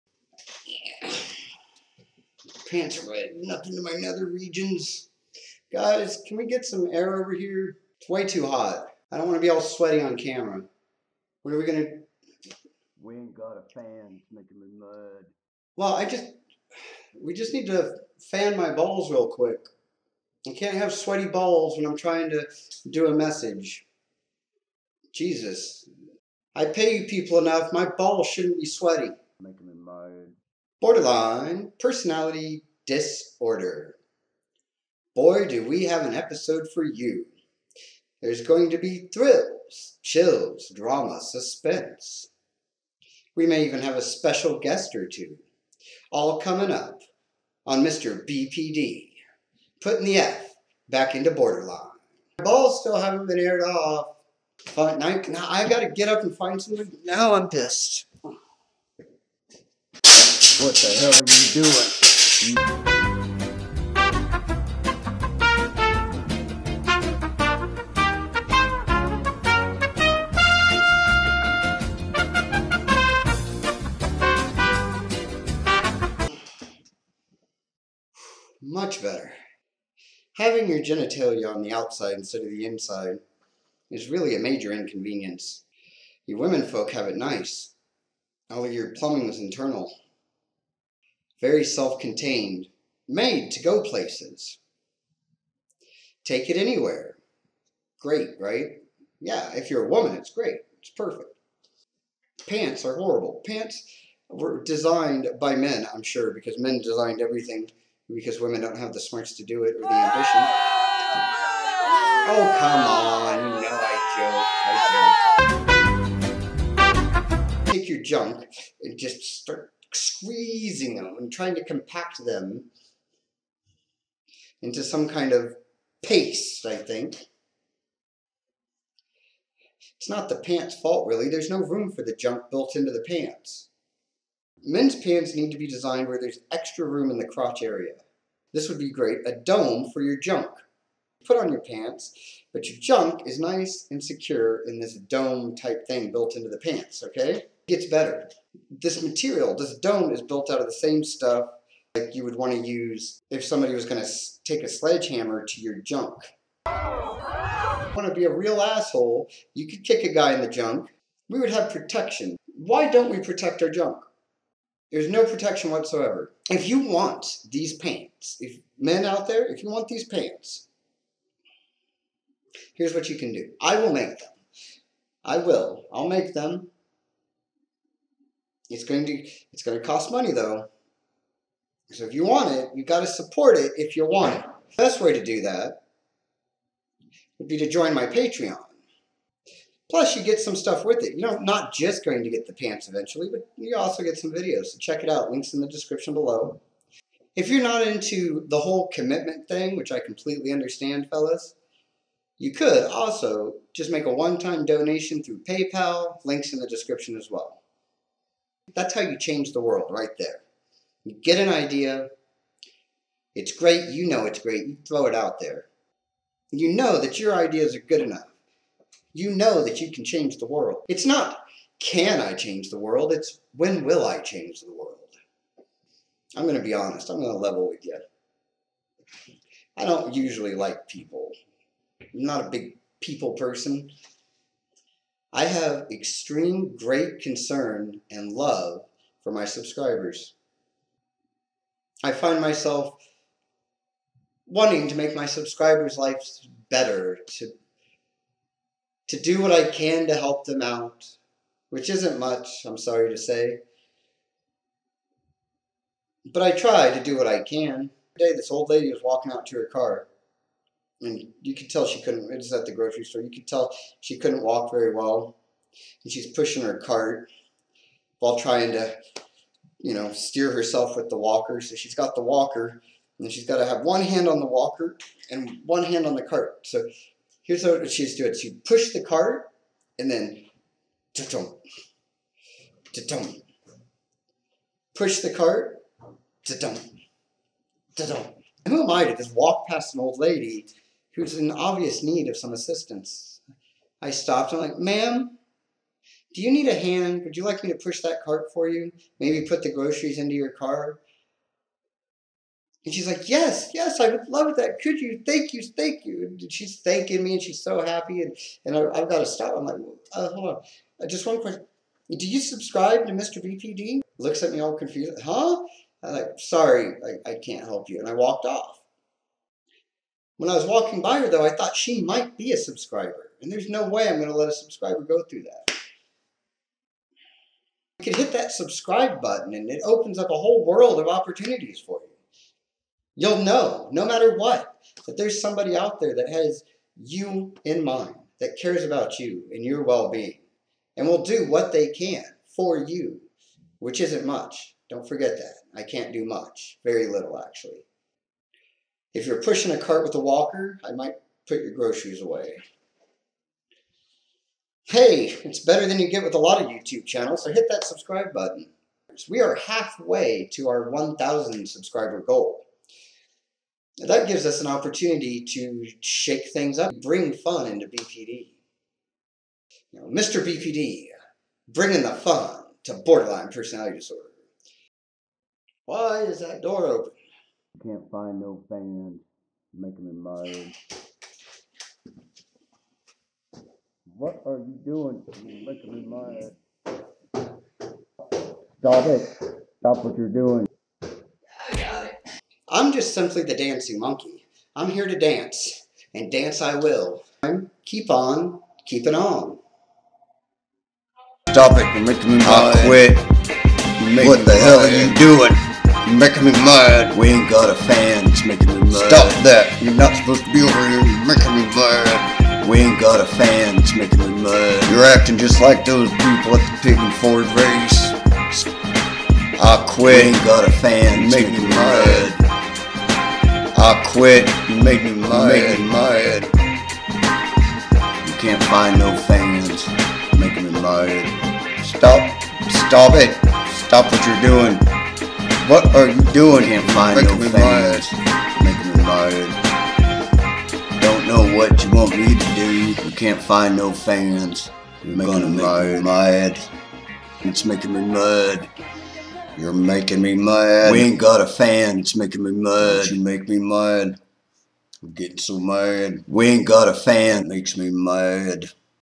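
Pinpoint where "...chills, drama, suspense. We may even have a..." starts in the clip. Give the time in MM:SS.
00:40.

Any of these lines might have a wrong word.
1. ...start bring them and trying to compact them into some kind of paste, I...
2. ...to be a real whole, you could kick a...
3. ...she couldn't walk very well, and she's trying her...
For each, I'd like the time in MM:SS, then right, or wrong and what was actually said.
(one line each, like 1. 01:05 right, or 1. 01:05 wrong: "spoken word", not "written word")
1. 01:59 wrong: "squeezing", not "bring"
2. 02:38 wrong: "asshole", not "whole"
3. 04:24 wrong: "pushing", not "trying".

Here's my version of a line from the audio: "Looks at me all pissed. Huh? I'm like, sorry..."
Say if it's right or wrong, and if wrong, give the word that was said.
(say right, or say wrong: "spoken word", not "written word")
wrong: "confused", not "pissed".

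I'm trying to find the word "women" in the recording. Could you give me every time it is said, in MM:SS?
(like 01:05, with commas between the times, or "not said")
01:26, 01:48.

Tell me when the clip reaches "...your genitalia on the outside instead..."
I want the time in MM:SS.
01:20.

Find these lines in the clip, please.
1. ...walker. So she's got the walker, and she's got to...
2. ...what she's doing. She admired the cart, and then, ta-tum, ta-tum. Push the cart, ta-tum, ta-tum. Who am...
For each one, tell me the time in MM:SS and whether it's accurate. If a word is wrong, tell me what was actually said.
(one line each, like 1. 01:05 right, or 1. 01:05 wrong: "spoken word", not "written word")
1. 04:31 right
2. 04:37 wrong: "pushed", not "admired".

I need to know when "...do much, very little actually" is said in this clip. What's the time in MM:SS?
05:46.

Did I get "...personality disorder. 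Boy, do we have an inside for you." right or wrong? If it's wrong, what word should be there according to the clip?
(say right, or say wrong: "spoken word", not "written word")
wrong: "episode", not "inside".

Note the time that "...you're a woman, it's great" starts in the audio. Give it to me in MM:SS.
01:39.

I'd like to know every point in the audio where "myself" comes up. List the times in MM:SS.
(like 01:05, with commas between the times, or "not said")
04:02.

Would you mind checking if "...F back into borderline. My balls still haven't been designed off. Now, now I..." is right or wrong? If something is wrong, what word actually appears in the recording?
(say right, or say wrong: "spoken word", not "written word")
wrong: "aired", not "designed".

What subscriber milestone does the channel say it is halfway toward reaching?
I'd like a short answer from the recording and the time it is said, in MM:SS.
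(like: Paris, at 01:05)
1,000 subscribers, at 06:00.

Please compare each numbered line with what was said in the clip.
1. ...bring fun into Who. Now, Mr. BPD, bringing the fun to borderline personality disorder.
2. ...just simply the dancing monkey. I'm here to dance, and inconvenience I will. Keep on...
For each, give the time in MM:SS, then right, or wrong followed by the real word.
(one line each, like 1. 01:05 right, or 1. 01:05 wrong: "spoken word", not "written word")
1. 06:07 wrong: "BPD", not "Who"
2. 06:32 wrong: "dance", not "inconvenience".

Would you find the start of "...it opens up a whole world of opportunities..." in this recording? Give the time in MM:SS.
05:29.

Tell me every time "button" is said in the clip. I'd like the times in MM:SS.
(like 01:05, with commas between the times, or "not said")
05:29, 05:58.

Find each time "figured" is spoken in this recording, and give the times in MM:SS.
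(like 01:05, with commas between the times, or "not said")
not said.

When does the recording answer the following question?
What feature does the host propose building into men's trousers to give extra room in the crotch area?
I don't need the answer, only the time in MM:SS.
02:19.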